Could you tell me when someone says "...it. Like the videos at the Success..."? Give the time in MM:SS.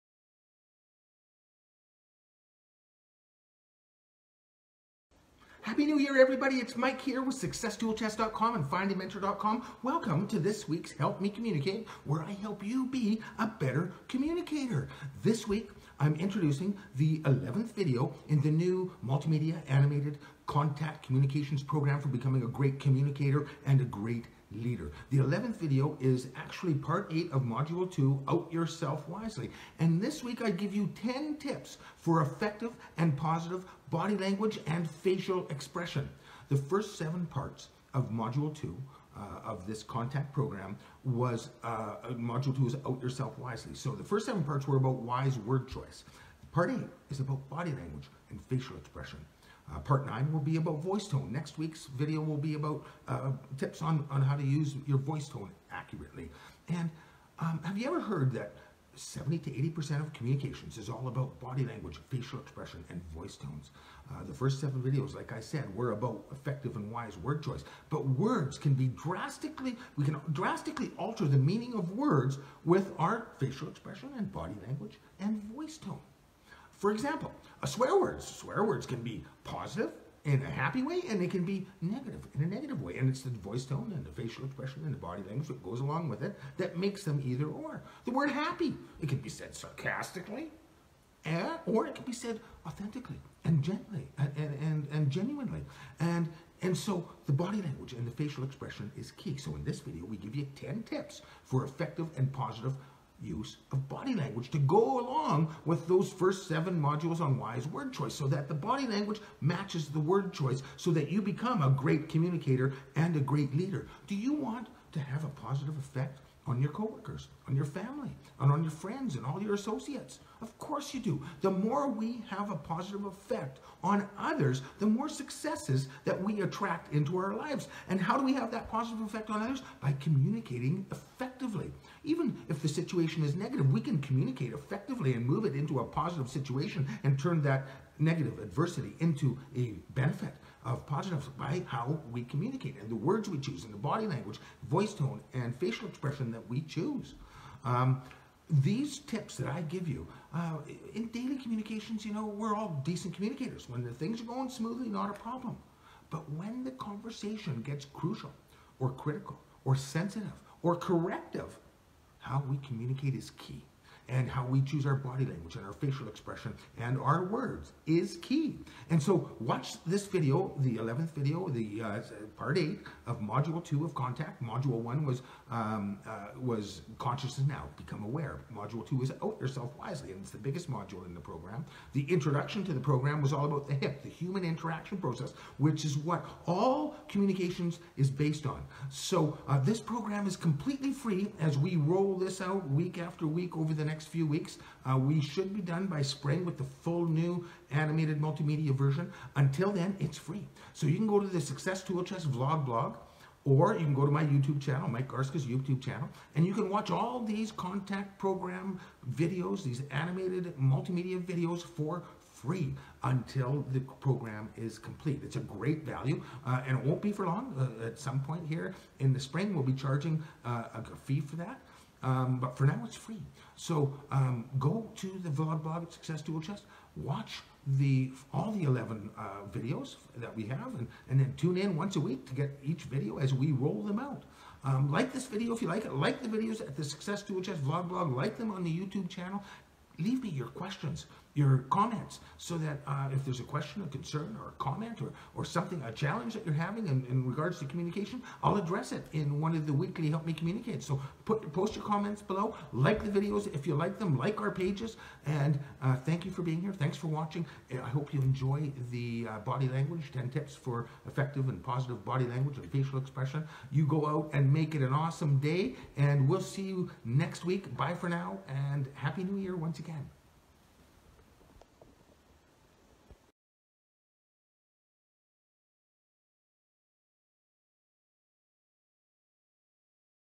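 03:55.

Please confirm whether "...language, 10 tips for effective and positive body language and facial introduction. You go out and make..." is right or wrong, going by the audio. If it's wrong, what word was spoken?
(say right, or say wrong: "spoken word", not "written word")
wrong: "expression", not "introduction".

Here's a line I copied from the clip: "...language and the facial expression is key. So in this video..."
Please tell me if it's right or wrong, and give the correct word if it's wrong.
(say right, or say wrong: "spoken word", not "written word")
right.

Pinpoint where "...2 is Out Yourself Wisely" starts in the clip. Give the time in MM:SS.
00:42.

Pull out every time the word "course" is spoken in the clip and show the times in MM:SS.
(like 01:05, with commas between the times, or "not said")
02:00.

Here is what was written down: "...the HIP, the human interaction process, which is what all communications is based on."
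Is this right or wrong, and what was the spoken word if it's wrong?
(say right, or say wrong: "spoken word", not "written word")
right.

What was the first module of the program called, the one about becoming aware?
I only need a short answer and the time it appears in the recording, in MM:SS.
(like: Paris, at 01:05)
Consciousness Now, at 02:56.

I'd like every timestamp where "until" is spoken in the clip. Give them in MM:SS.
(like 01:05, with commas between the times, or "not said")
03:19, 03:33.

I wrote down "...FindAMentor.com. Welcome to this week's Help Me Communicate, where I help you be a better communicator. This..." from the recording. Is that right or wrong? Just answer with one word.
right.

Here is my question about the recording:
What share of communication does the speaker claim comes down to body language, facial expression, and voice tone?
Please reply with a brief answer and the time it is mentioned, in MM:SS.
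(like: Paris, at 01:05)
70 to 80%, at 00:58.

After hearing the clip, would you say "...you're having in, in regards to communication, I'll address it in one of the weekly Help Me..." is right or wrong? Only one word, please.
right.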